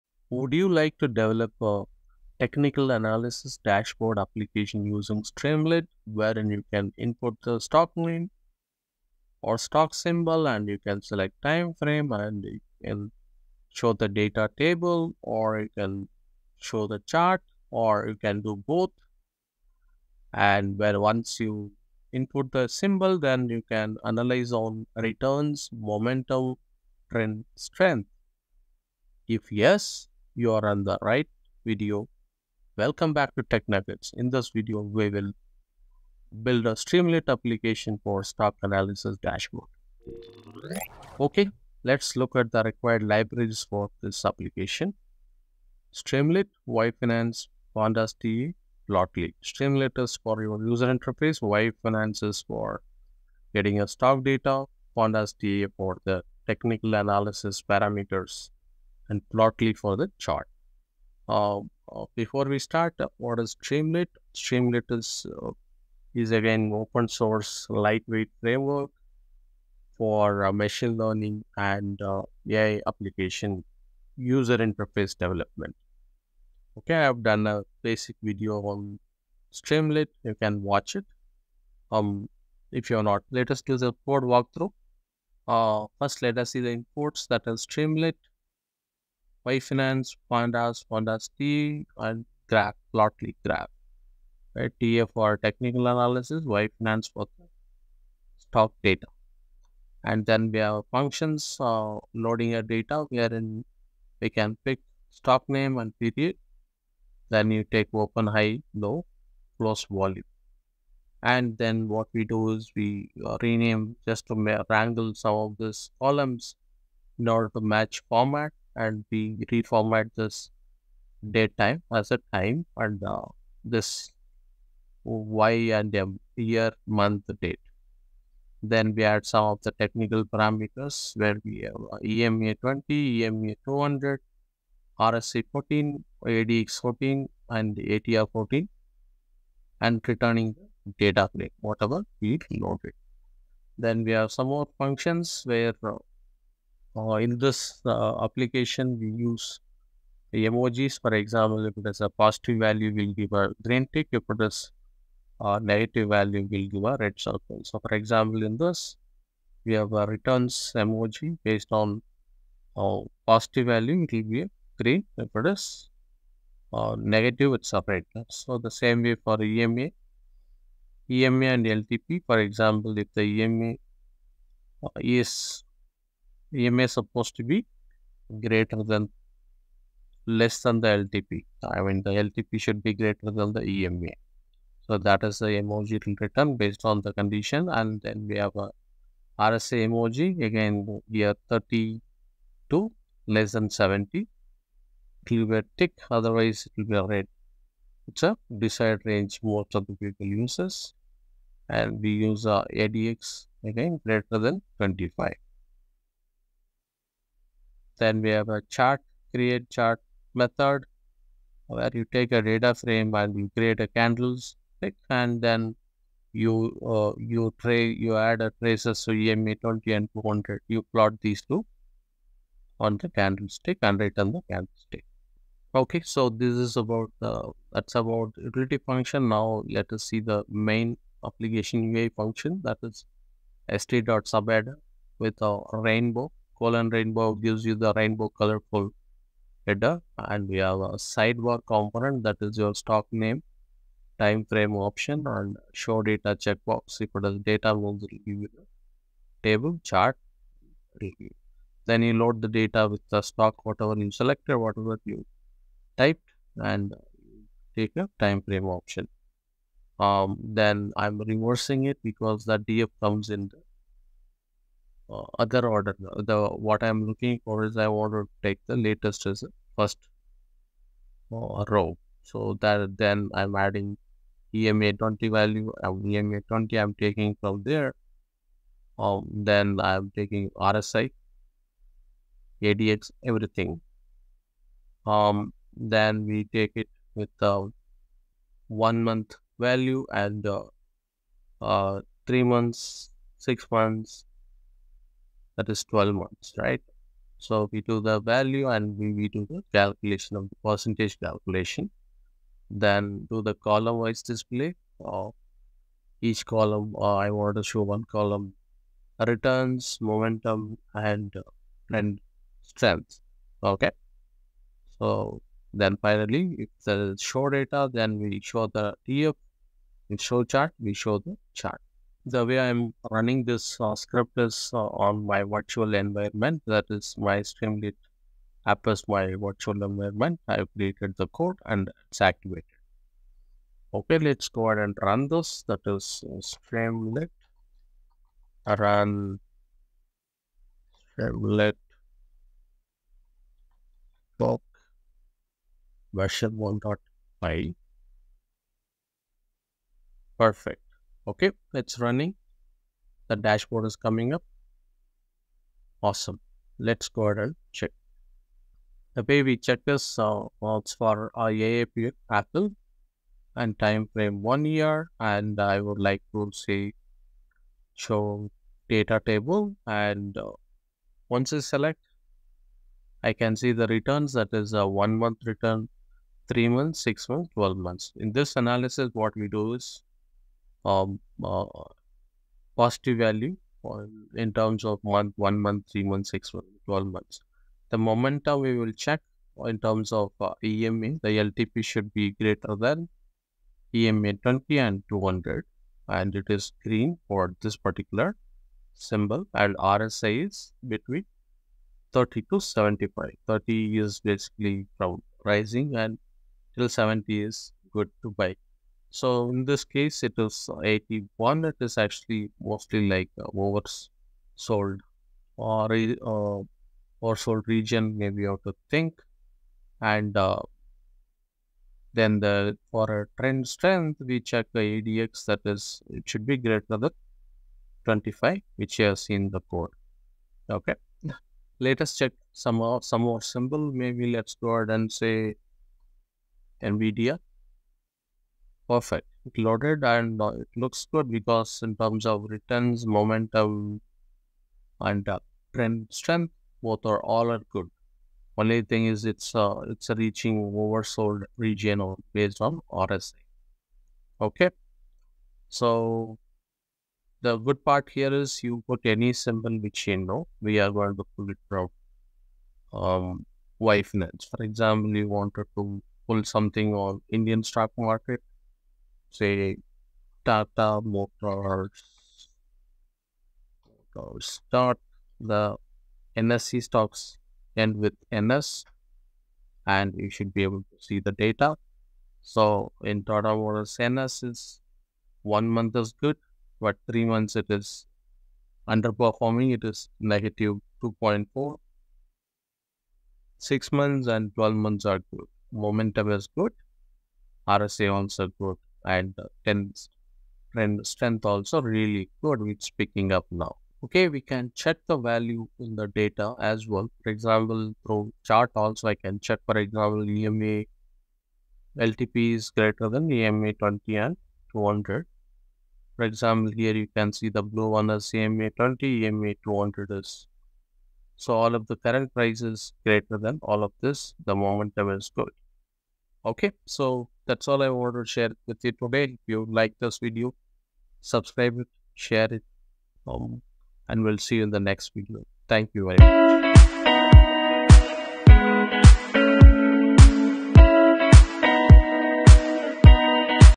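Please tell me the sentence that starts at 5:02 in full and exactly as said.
Then do the column wise display.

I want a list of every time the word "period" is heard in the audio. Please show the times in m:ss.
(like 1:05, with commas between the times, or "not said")
1:45.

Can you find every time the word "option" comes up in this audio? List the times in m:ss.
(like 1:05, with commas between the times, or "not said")
4:04, 4:18.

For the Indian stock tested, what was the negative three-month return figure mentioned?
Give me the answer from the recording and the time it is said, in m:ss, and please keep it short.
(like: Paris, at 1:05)
-2.4%, at 8:10.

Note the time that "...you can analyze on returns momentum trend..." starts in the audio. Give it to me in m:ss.
0:23.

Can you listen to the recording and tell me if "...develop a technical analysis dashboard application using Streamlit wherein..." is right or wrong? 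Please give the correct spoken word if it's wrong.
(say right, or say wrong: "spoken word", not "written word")
right.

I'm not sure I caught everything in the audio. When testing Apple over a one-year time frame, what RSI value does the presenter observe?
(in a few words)
81.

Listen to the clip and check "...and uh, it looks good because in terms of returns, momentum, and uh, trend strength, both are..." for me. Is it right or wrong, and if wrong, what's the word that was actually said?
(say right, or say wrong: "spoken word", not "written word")
right.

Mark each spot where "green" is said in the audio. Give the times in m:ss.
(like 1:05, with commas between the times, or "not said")
2:33, 2:44, 6:36.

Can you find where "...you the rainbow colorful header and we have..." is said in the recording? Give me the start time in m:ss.
3:57.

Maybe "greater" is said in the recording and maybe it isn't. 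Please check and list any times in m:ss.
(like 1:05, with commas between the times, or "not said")
2:58, 3:02, 3:24, 6:32, 7:06, 8:32, 8:43.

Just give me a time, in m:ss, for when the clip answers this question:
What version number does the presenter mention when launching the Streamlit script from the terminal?
5:46.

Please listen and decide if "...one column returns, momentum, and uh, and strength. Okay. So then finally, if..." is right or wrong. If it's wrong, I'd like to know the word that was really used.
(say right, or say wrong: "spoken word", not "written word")
right.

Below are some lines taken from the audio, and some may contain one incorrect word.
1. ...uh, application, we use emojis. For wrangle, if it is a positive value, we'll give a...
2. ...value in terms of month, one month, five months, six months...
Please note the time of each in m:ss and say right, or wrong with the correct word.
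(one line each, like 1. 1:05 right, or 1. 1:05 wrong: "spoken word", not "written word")
1. 2:27 wrong: "example", not "wrangle"
2. 6:23 wrong: "three", not "five".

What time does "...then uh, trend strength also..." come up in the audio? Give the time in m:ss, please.
8:19.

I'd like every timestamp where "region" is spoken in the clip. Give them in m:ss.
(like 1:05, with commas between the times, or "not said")
6:57, 7:31.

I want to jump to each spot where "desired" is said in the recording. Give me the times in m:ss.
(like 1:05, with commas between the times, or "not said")
3:18.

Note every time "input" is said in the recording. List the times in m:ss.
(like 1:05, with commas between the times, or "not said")
0:06, 0:22.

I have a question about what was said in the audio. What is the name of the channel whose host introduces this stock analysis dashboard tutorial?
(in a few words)
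Tech Nuggets.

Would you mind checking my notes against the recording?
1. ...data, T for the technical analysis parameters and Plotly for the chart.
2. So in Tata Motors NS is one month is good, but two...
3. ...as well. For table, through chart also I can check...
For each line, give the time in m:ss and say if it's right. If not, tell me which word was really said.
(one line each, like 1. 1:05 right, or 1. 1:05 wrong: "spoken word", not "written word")
1. 0:54 right
2. 8:02 wrong: "three", not "two"
3. 8:26 wrong: "example", not "table".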